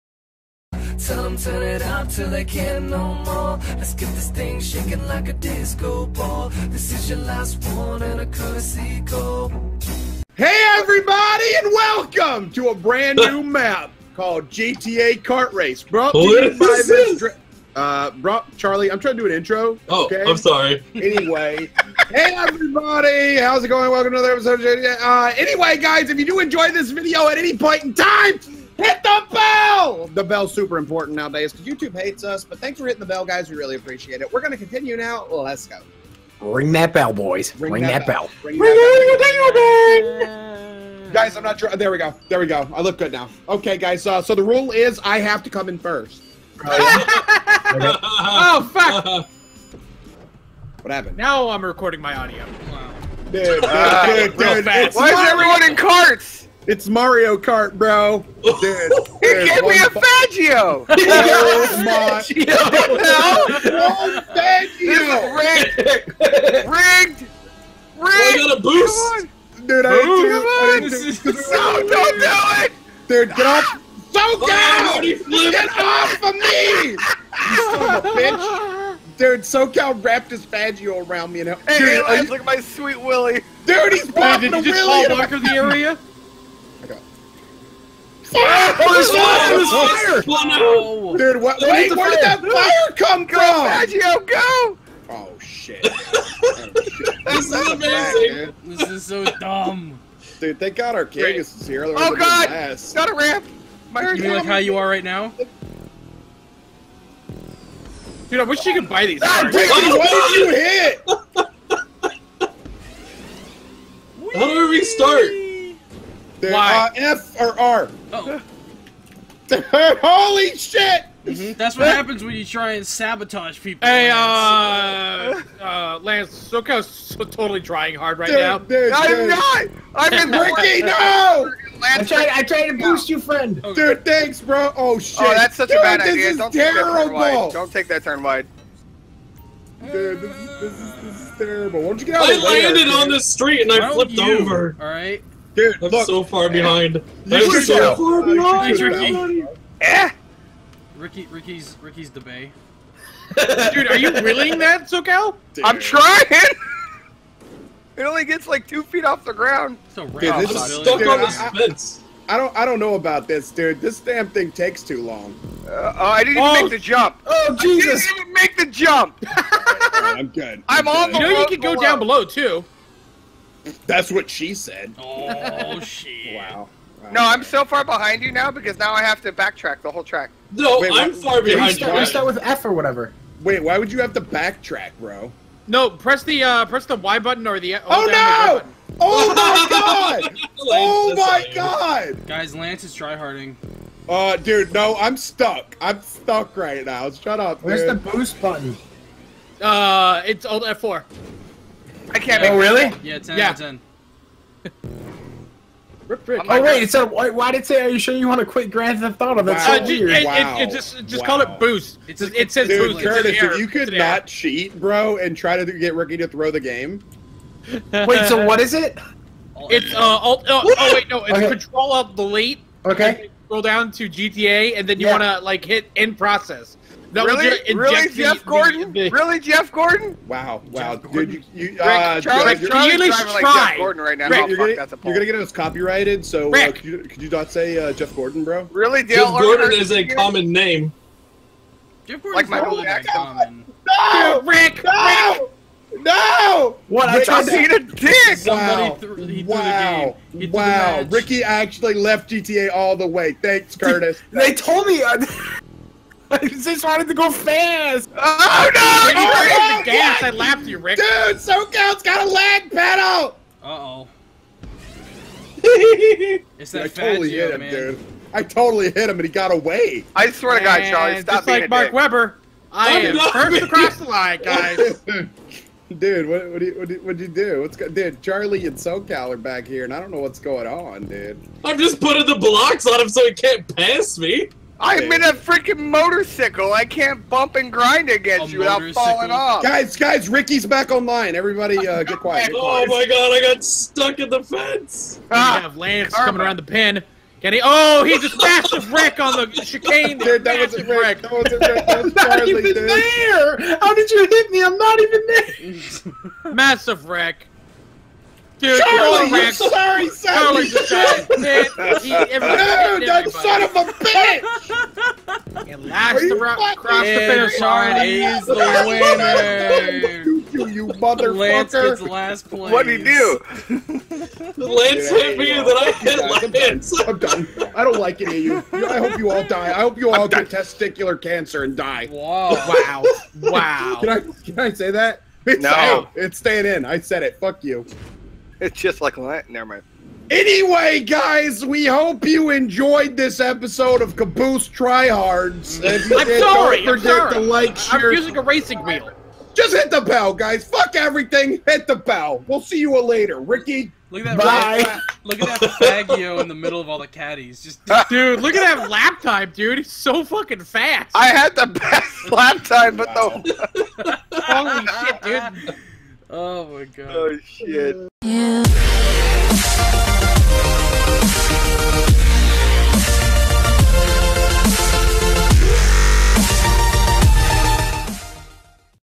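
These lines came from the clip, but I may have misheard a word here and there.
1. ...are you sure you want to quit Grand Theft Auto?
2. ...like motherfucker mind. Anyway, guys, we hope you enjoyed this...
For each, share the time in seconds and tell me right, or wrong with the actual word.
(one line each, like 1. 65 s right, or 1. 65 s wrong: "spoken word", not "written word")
1. 207 s right
2. 339 s wrong: "never", not "motherfucker".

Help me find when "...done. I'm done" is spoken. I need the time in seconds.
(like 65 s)
327 s.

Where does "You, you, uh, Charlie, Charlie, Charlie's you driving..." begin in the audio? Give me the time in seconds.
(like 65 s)
231 s.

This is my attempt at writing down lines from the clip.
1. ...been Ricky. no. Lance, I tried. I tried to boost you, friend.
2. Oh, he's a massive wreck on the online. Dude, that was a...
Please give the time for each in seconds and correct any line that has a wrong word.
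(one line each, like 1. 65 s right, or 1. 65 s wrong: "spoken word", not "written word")
1. 130 s right
2. 297 s wrong: "chicane", not "online".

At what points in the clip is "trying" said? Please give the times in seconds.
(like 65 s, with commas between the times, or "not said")
18 s, 127 s, 155 s.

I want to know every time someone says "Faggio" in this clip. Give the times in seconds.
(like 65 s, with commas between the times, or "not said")
59 s, 64 s, 80 s, 356 s.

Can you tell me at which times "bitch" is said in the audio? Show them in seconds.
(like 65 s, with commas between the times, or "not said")
78 s, 313 s.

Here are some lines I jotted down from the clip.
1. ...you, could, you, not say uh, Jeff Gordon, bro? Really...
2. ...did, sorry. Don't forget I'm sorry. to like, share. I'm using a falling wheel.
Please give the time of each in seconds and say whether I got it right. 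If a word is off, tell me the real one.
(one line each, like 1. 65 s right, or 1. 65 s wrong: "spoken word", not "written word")
1. 236 s right
2. 346 s wrong: "racing", not "falling".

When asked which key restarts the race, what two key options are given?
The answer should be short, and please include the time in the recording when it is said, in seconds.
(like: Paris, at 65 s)
F or R, at 116 s.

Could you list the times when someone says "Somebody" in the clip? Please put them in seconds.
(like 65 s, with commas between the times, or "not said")
248 s.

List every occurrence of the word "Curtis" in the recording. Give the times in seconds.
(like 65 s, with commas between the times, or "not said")
213 s, 253 s.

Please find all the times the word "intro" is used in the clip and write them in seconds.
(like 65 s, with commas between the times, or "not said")
19 s.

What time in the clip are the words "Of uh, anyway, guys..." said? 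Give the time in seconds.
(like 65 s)
24 s.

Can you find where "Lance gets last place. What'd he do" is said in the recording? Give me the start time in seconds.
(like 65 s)
321 s.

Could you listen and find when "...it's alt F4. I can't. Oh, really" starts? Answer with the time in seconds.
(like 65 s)
200 s.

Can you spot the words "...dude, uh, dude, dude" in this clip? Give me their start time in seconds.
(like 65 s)
53 s.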